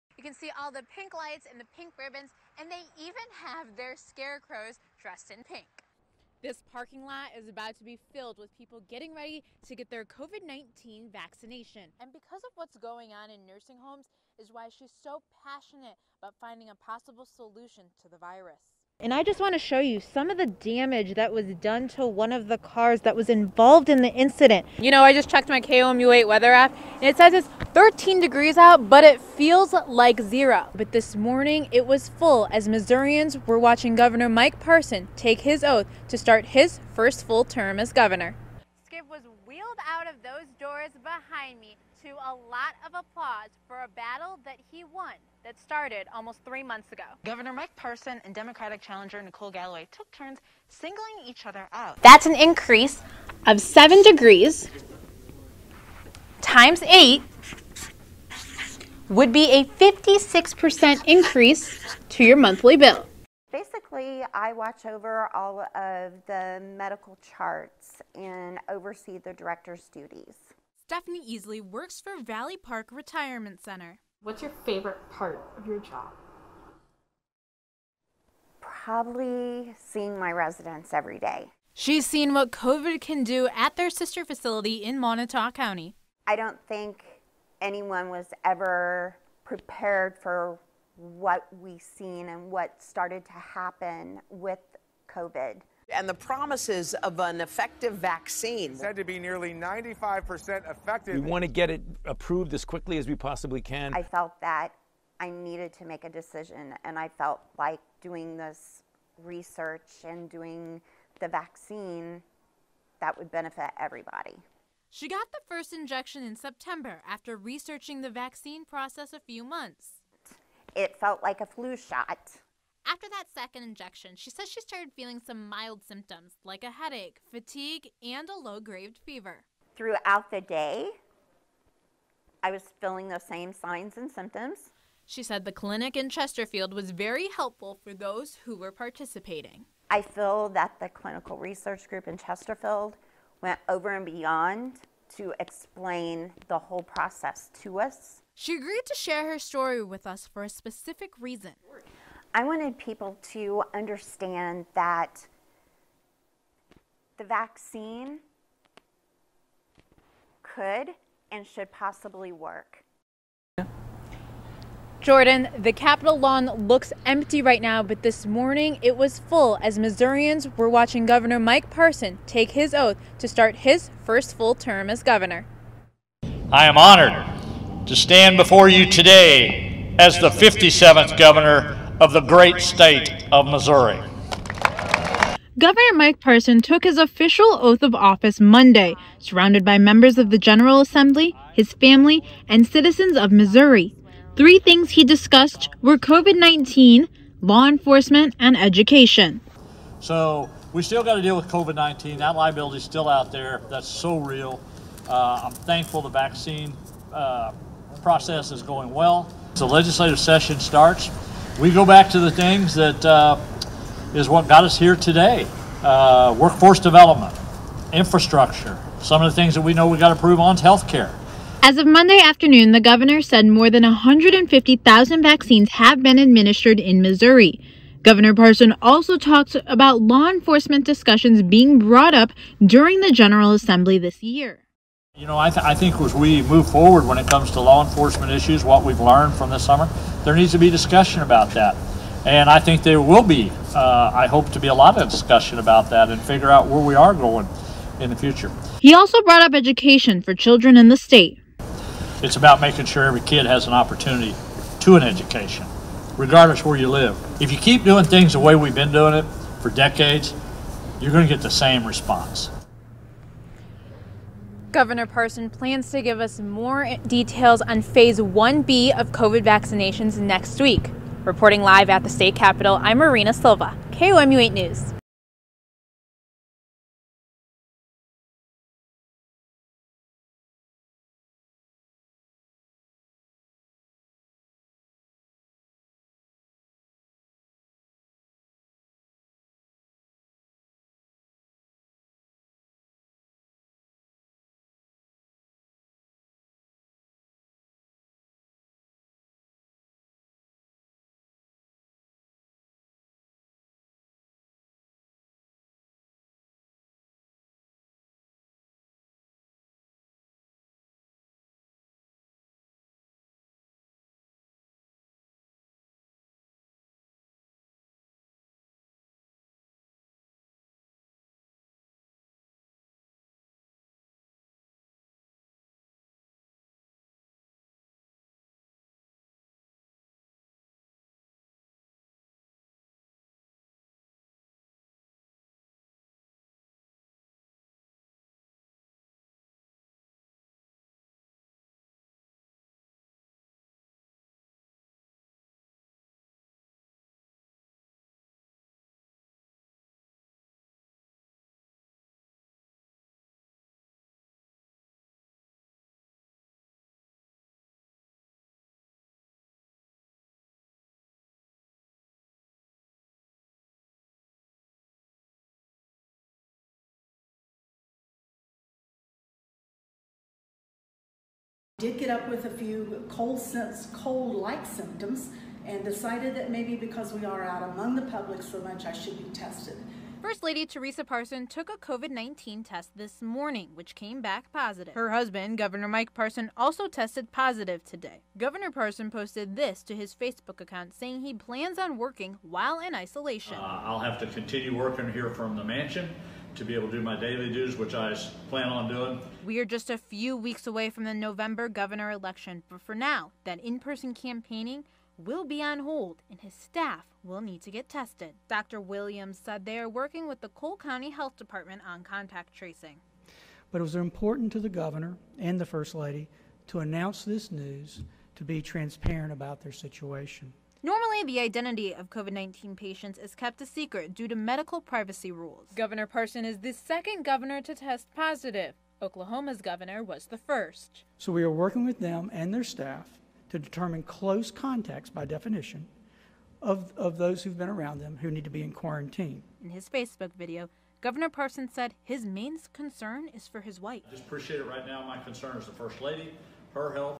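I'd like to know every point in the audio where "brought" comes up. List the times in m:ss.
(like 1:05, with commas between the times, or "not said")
3:51, 4:09.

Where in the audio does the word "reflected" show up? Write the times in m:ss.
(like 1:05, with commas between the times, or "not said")
not said.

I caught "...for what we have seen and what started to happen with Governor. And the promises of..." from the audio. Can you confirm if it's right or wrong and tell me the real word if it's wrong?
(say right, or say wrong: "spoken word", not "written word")
wrong: "COVID", not "Governor".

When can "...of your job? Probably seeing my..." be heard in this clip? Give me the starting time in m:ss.
1:15.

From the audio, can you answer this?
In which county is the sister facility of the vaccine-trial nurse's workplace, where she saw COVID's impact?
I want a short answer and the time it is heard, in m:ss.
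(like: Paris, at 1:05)
Montauk County, at 1:24.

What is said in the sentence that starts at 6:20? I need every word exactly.
First Lady Teresa Parson took a COVID 19 test this morning, which came back positive.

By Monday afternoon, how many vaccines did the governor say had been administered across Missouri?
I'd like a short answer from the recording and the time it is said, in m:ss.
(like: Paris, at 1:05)
150,000, at 3:43.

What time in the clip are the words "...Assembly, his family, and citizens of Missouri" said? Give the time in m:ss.
3:10.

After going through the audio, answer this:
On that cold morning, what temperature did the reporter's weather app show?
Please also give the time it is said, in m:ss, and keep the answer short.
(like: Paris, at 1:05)
13 degrees, at 0:27.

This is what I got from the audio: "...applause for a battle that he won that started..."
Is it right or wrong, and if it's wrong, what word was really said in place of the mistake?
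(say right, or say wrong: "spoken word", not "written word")
right.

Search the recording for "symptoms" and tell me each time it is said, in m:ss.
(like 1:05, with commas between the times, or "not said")
2:05, 2:14, 6:14.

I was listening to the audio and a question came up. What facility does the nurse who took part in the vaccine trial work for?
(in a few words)
Valley Park Retirement Center.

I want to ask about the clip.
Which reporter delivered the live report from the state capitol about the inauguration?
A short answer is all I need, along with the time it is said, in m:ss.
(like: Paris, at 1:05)
Marina Silva, at 4:32.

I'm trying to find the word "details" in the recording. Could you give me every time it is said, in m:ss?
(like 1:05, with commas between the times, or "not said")
4:27.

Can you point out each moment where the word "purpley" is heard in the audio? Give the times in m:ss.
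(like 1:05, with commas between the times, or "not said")
not said.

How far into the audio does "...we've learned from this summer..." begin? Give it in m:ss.
3:58.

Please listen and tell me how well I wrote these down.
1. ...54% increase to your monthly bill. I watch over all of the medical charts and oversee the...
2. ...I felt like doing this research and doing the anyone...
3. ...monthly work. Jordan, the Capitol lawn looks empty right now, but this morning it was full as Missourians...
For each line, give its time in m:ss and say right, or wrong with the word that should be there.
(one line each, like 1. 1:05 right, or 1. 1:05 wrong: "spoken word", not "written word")
1. 0:59 wrong: "56", not "54"
2. 1:46 wrong: "vaccine", not "anyone"
3. 2:41 wrong: "possibly", not "monthly".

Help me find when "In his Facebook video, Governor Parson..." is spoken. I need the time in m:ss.
7:19.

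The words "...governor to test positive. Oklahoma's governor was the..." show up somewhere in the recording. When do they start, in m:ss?
7:07.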